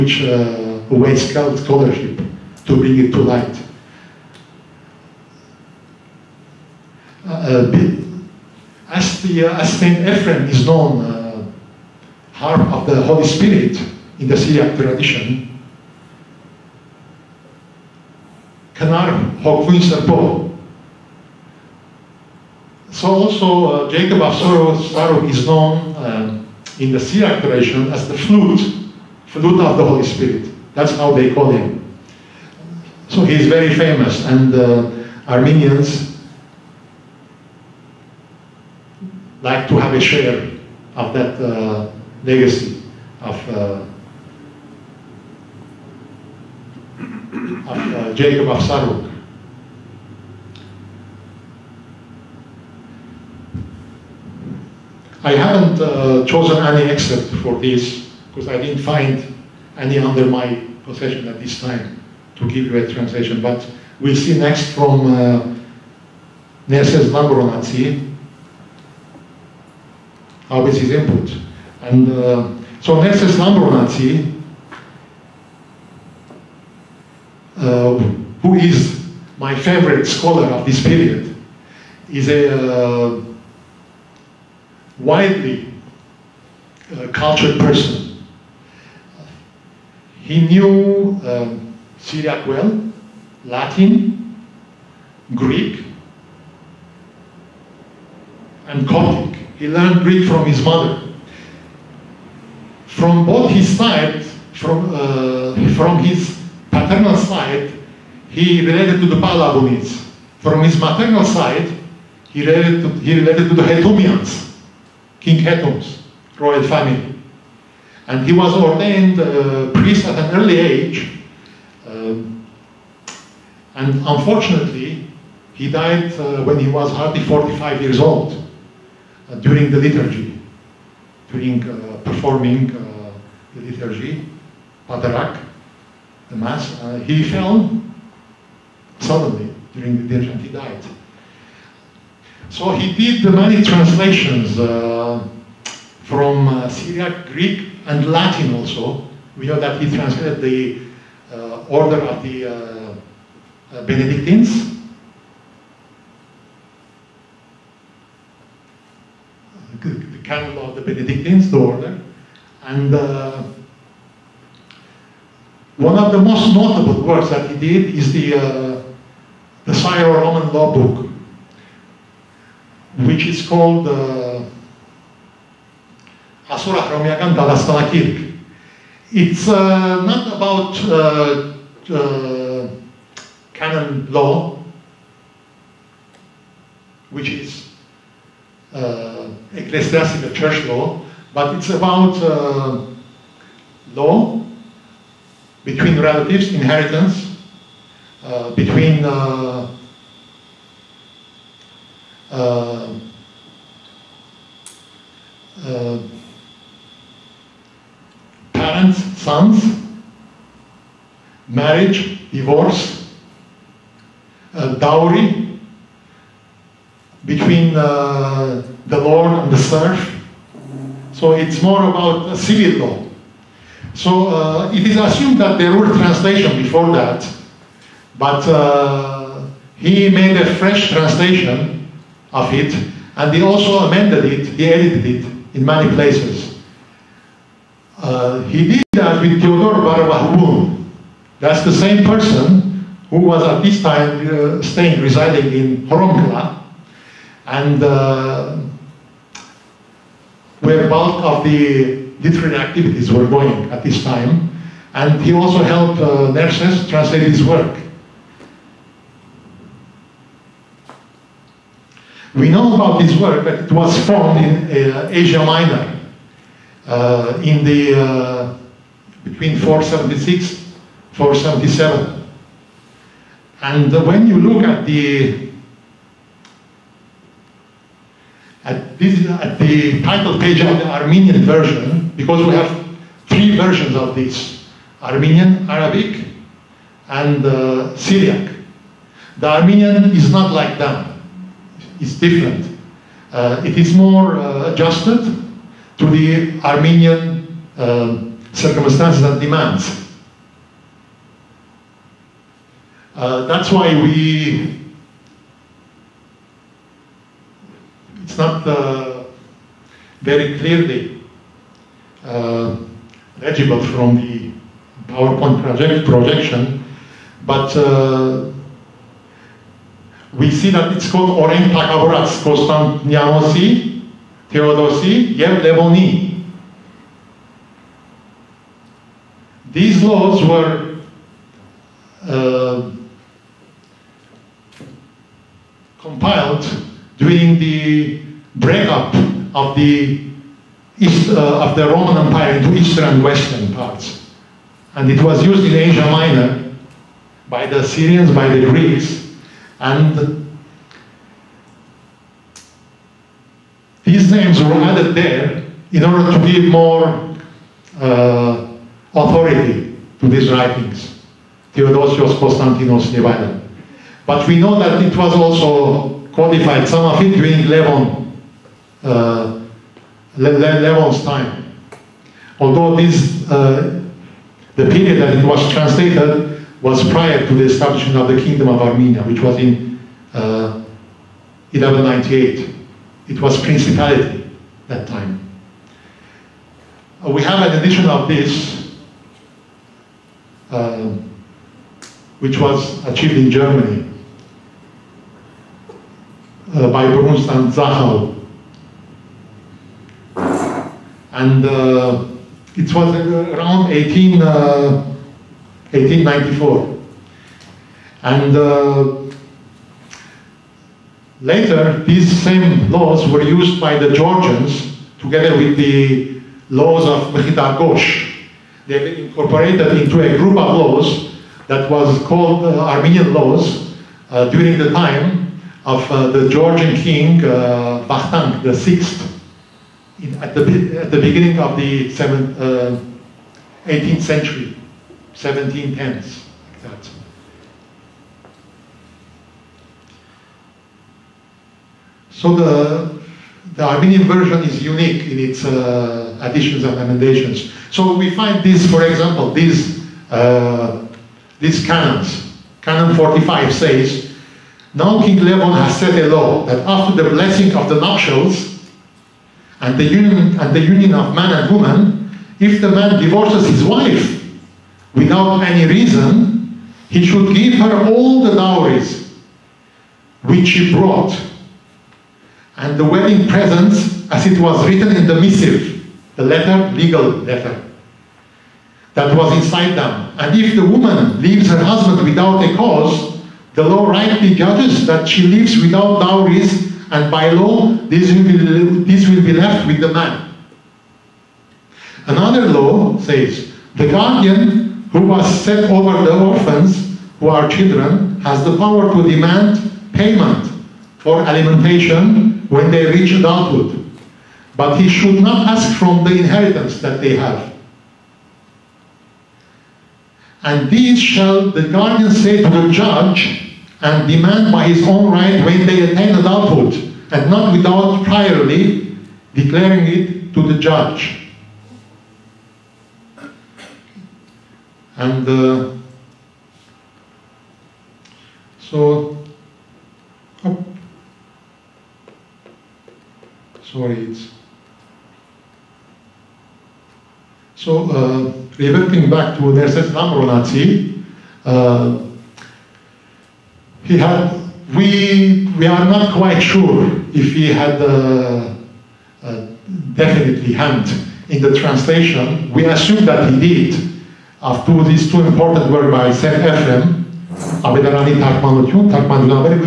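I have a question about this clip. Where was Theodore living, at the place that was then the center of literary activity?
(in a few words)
Horomkla.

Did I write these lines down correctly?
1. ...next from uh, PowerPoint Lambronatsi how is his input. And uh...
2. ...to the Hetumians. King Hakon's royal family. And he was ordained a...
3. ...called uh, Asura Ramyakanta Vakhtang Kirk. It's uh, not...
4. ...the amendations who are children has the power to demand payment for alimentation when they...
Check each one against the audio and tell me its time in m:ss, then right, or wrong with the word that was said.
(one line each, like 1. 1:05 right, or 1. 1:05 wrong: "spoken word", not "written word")
1. 1:04 wrong: "Nerses", not "PowerPoint"
2. 1:53 right
3. 2:53 wrong: "Lastana", not "Vakhtang"
4. 8:16 wrong: "orphans", not "amendations".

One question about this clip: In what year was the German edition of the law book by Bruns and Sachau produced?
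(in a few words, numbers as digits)
1894.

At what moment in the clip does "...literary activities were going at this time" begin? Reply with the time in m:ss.
4:12.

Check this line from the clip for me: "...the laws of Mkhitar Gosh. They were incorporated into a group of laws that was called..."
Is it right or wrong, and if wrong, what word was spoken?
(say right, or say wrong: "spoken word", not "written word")
right.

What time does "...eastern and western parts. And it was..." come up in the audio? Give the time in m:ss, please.
5:42.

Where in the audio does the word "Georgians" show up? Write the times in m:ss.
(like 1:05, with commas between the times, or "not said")
6:54, 7:06.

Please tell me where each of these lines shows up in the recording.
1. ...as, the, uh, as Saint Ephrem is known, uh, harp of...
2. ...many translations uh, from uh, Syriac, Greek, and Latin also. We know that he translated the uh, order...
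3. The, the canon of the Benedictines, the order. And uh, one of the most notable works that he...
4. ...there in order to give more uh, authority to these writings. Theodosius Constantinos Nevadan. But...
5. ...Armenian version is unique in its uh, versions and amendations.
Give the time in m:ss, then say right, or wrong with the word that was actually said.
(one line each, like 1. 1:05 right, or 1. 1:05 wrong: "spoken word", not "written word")
1. 0:08 right
2. 2:23 right
3. 2:39 right
4. 5:55 right
5. 7:23 wrong: "additions", not "versions".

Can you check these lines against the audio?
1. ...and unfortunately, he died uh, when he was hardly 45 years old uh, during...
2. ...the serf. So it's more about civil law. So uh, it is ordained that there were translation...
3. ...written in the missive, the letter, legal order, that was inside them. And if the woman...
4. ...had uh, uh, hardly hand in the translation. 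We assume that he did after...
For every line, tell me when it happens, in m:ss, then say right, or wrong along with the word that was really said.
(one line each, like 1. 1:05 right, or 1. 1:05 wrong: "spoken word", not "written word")
1. 2:03 right
2. 3:39 wrong: "assumed", not "ordained"
3. 7:54 wrong: "letter", not "order"
4. 9:07 wrong: "definitely", not "hardly".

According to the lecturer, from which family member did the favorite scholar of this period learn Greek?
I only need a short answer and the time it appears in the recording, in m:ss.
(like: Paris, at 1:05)
His mother, at 1:40.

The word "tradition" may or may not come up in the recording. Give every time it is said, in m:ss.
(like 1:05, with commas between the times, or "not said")
0:14, 0:27.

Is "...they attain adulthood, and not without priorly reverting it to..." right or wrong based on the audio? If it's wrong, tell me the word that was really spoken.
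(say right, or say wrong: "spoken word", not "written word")
wrong: "declaring", not "reverting".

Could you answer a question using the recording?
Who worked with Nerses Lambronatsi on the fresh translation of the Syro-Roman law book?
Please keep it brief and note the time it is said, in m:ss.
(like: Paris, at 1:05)
Theodore Barabahoun, at 3:59.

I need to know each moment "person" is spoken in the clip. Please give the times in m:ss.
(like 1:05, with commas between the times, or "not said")
1:27, 4:02.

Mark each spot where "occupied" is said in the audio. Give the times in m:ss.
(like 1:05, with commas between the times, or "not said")
not said.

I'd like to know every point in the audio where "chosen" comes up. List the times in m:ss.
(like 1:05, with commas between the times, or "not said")
0:56.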